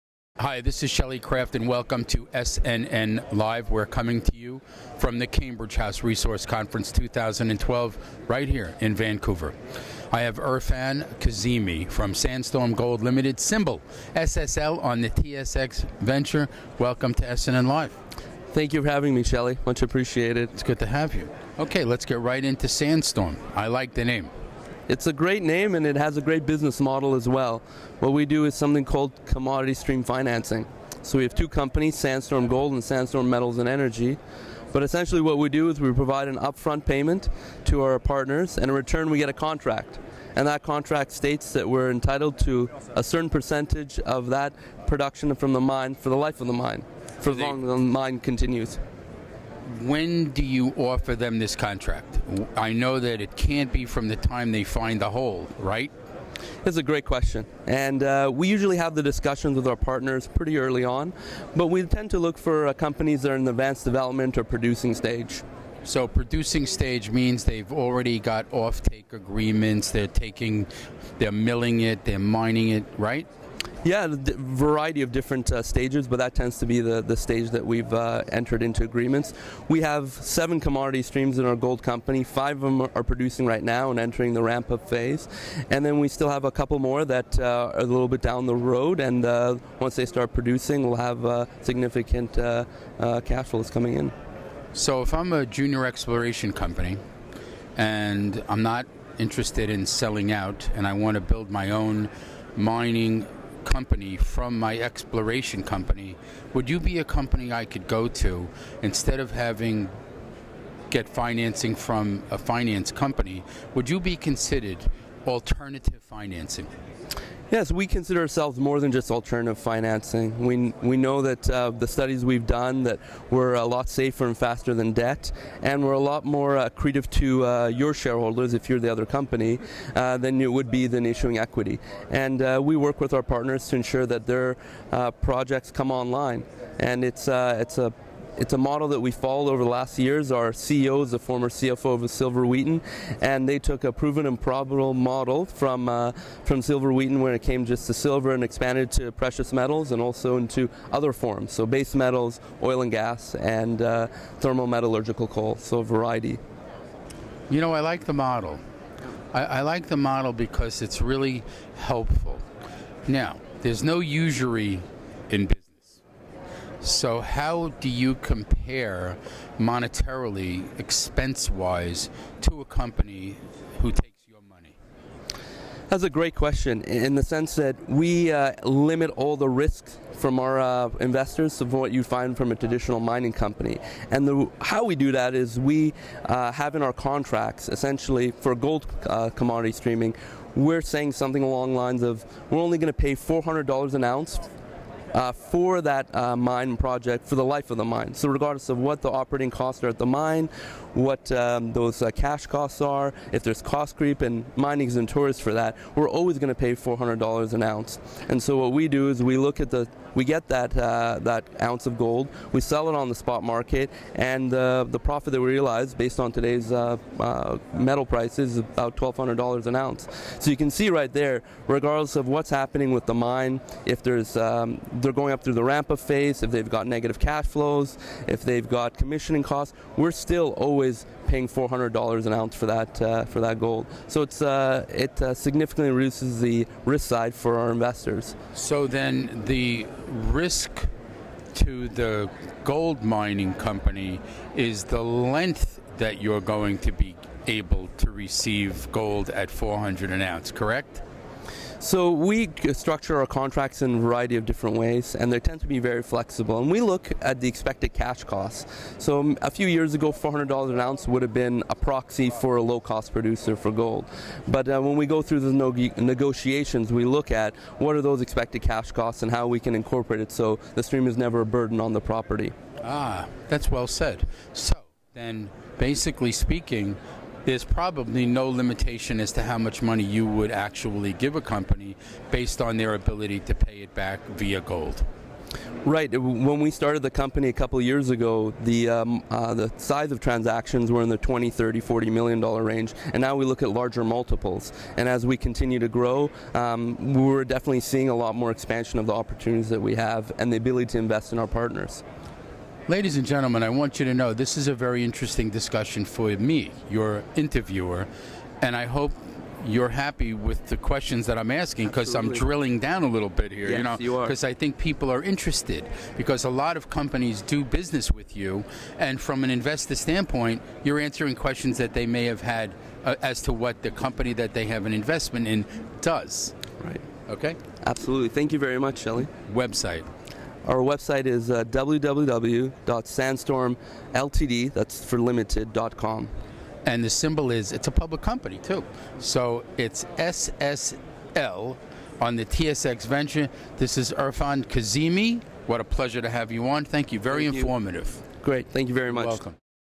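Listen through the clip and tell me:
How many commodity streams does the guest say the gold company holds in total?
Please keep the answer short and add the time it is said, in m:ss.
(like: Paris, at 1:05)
7, at 1:20.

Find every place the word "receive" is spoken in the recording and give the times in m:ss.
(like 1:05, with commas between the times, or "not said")
4:08.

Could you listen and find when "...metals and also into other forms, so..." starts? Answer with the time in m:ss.
2:29.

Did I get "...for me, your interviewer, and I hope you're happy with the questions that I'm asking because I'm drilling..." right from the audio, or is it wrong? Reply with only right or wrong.
right.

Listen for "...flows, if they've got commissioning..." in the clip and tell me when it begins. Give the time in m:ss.
3:47.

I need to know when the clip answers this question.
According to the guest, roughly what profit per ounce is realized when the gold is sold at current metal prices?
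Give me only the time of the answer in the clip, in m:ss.
3:38.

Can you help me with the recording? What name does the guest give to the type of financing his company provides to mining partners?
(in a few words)
Commodity stream financing.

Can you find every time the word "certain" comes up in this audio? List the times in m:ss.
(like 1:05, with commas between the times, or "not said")
0:43.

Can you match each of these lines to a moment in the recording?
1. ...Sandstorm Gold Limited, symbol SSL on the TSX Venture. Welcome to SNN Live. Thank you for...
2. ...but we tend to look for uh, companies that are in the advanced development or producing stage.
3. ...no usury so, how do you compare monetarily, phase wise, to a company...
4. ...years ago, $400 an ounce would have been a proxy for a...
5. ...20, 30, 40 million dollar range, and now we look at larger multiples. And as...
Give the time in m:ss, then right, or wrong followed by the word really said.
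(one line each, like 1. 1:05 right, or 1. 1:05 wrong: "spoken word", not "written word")
1. 0:12 right
2. 1:01 right
3. 2:43 wrong: "expense", not "phase"
4. 4:19 right
5. 4:51 right.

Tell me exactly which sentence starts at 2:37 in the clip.
You know, I like the model.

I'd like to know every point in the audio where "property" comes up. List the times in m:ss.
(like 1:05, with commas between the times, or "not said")
4:32.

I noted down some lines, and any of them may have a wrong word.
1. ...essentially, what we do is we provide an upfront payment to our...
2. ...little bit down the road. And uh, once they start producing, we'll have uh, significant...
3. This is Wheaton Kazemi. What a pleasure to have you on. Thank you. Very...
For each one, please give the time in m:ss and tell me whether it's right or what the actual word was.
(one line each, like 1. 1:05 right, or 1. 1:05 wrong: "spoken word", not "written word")
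1. 0:34 right
2. 1:27 right
3. 5:43 wrong: "Erfan", not "Wheaton".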